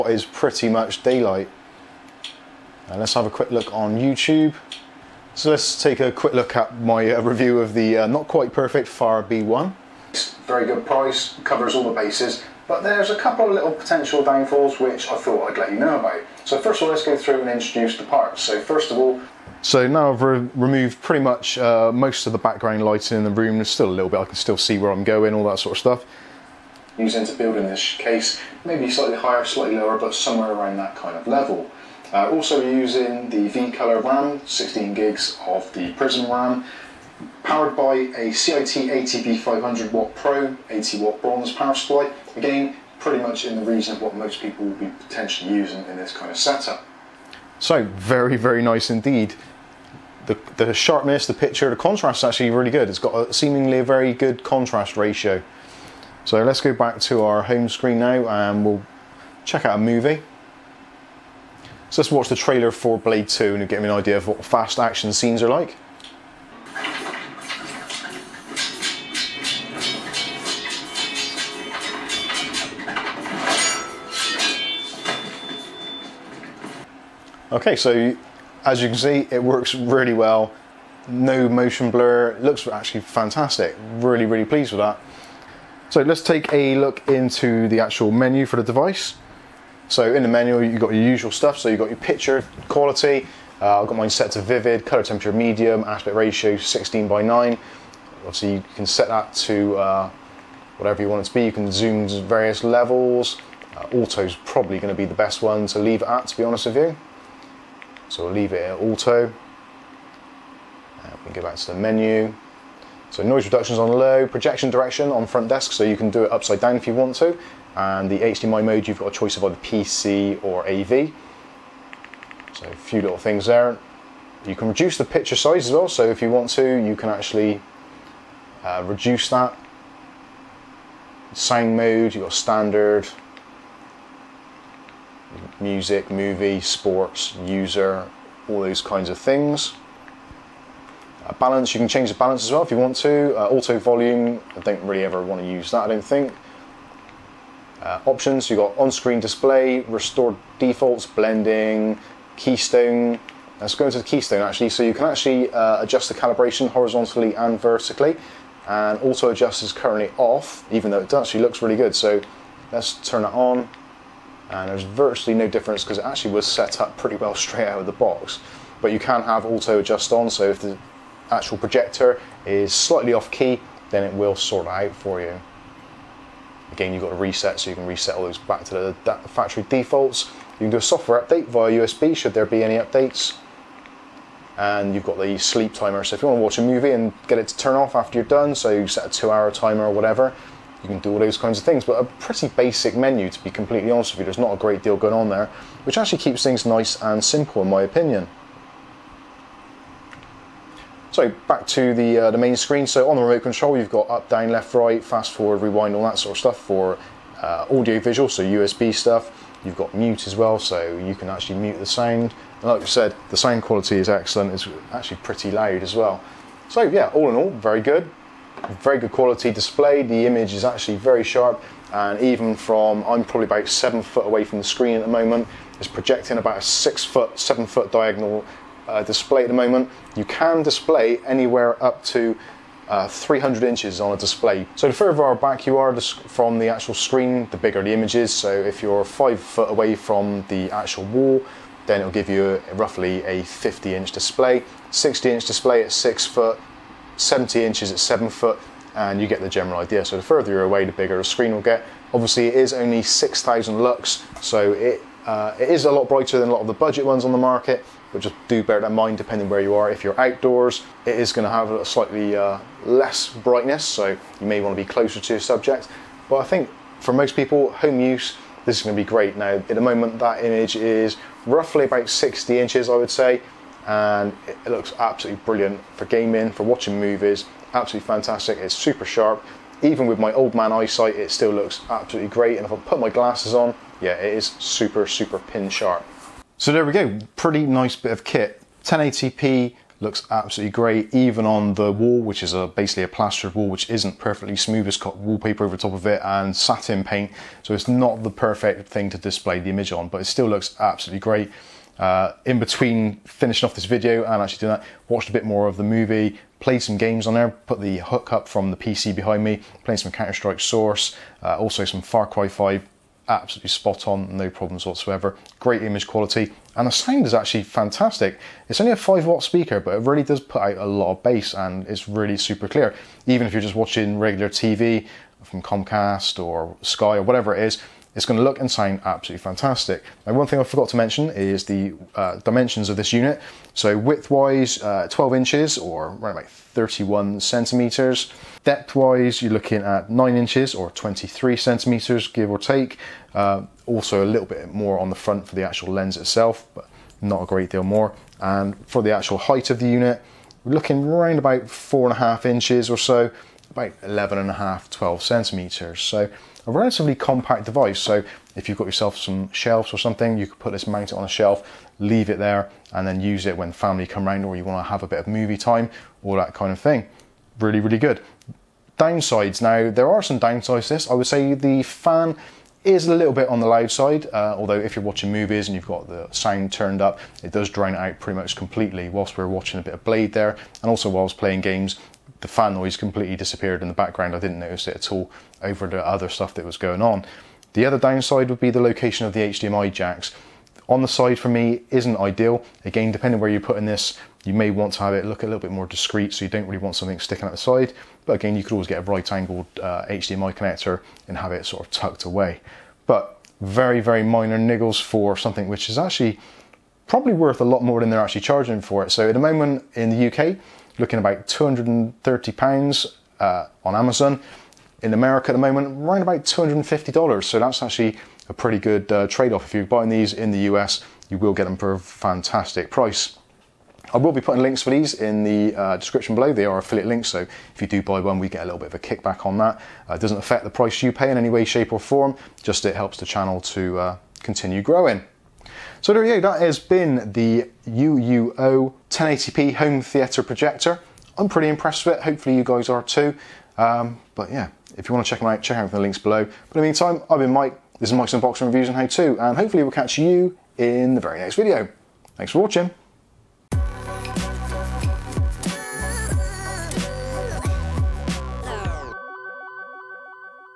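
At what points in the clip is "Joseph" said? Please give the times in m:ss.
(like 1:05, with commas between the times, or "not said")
not said.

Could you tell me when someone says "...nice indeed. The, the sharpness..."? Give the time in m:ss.
0:48.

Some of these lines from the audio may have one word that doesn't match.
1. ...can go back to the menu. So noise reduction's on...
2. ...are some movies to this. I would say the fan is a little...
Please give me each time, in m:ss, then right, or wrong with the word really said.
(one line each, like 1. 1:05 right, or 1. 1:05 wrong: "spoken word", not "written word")
1. 1:51 right
2. 6:10 wrong: "downsides", not "movies".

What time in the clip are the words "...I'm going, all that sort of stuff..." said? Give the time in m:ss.
0:24.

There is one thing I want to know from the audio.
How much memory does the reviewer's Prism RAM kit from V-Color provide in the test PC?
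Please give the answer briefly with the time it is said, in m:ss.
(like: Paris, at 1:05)
16 gigs, at 0:34.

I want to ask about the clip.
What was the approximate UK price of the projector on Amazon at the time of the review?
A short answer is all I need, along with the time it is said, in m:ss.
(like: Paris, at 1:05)
230 pounds, at 6:51.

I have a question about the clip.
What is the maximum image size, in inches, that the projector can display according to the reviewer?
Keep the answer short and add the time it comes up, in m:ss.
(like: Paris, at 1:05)
300 inches, at 3:53.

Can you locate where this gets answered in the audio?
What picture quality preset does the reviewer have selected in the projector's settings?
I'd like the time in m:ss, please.
1:34.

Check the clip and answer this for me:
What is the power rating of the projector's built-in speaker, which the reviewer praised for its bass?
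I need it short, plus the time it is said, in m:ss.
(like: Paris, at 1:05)
5 watt, at 5:18.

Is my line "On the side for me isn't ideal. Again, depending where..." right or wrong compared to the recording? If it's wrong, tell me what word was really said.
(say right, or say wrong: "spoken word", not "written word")
right.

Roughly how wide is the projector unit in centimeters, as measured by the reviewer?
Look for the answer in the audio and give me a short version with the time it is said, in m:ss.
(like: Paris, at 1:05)
31 centimeters, at 5:36.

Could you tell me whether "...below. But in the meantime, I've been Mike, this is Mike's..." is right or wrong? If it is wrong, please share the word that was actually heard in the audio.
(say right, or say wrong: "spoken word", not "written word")
right.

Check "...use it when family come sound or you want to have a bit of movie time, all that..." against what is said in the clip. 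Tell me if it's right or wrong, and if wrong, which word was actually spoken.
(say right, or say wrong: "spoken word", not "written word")
wrong: "round", not "sound".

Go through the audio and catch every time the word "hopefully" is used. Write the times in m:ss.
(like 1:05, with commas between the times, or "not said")
7:22, 7:29.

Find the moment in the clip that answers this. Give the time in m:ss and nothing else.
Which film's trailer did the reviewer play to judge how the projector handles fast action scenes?
1:02.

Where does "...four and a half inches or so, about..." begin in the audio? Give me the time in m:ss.
5:51.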